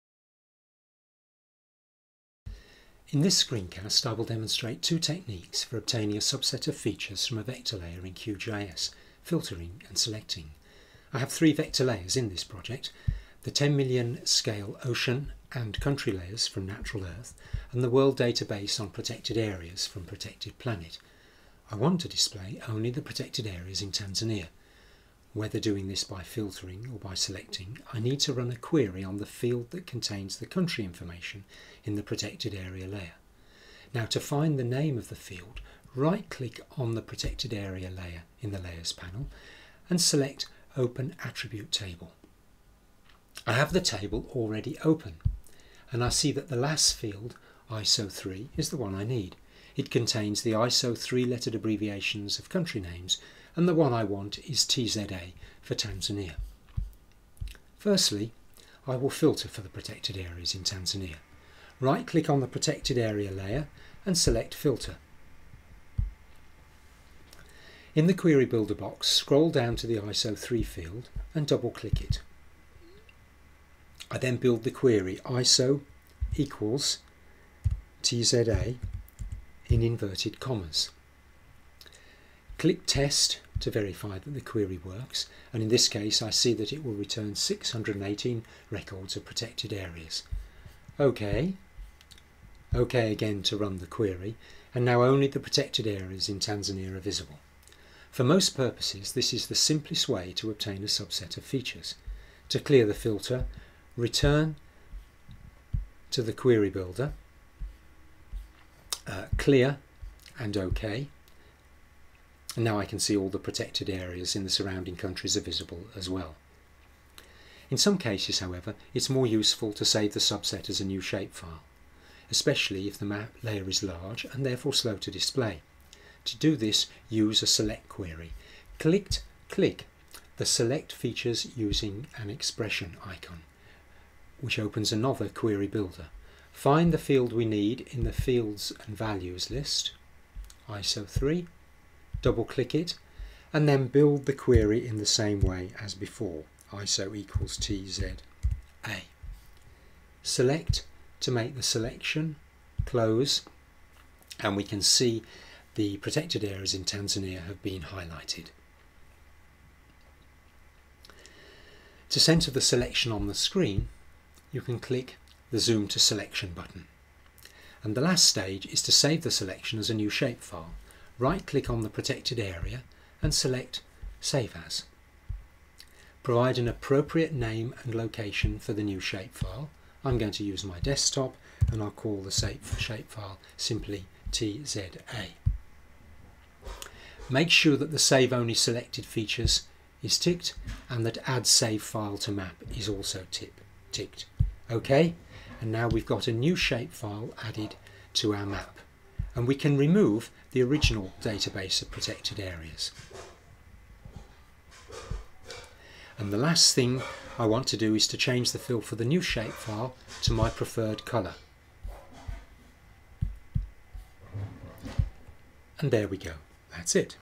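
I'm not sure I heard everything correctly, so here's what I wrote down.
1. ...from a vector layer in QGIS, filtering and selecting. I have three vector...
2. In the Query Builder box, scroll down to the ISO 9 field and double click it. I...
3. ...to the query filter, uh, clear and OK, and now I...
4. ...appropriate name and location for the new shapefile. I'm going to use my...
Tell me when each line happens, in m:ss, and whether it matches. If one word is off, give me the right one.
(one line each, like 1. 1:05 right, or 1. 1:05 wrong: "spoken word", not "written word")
1. 0:07 right
2. 1:07 wrong: "3", not "9"
3. 1:46 wrong: "builder", not "filter"
4. 2:56 right.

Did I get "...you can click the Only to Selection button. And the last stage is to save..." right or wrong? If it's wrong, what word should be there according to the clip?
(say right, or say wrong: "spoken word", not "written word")
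wrong: "Zoom", not "Only".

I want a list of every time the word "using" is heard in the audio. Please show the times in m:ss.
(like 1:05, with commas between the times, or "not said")
2:11.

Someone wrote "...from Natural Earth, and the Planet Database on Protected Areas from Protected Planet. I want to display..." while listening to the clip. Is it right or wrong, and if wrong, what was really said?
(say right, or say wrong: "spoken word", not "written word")
wrong: "World", not "Planet".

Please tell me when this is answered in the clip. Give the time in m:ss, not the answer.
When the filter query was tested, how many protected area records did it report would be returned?
1:27.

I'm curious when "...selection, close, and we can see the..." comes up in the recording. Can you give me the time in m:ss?
2:31.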